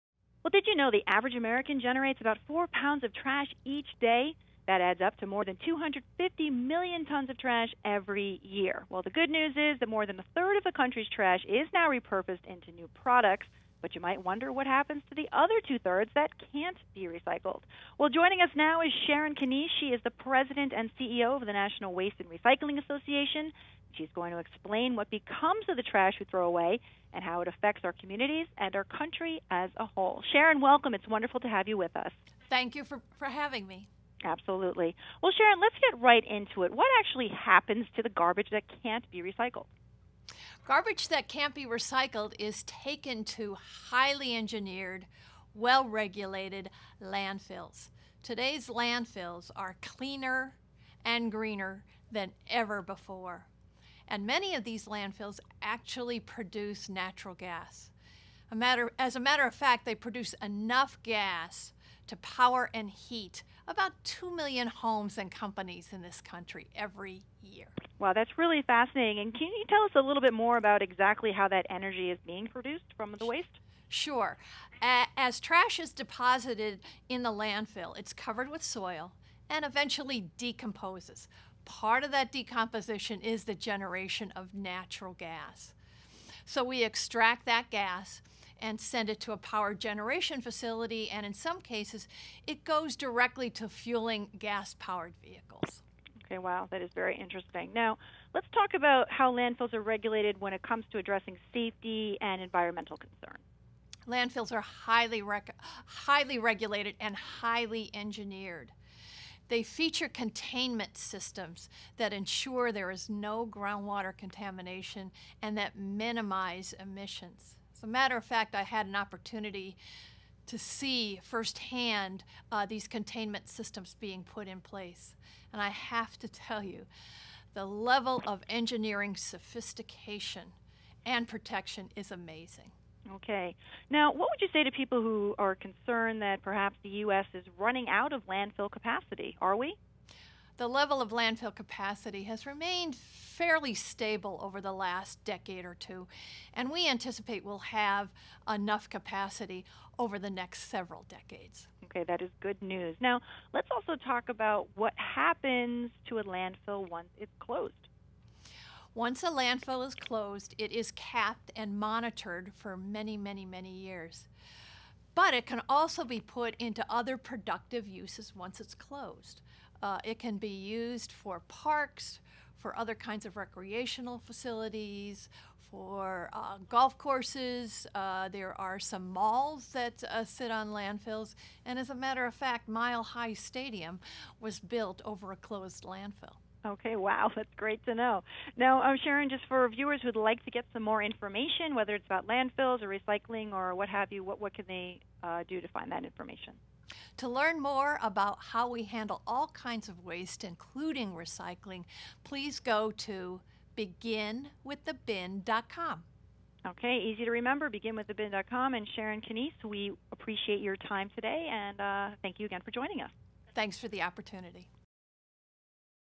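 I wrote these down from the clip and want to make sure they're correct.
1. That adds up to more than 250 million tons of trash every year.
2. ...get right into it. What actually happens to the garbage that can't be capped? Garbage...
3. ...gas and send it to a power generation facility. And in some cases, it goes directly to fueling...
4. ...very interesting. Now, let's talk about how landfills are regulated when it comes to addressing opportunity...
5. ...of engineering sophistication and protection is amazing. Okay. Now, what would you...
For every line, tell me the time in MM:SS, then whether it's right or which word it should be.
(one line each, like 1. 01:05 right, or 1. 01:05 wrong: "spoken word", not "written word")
1. 00:04 right
2. 00:35 wrong: "recycled", not "capped"
3. 01:27 right
4. 01:36 wrong: "safety", not "opportunity"
5. 02:08 right.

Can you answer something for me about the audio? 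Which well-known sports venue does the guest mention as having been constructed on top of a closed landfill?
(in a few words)
Mile High Stadium.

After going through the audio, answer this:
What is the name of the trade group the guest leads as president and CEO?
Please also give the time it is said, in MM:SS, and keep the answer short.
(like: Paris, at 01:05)
National Waste and Recycling Association, at 00:21.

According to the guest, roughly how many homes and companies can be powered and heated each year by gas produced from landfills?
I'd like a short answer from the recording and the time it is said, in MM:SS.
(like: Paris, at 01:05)
2 million, at 01:04.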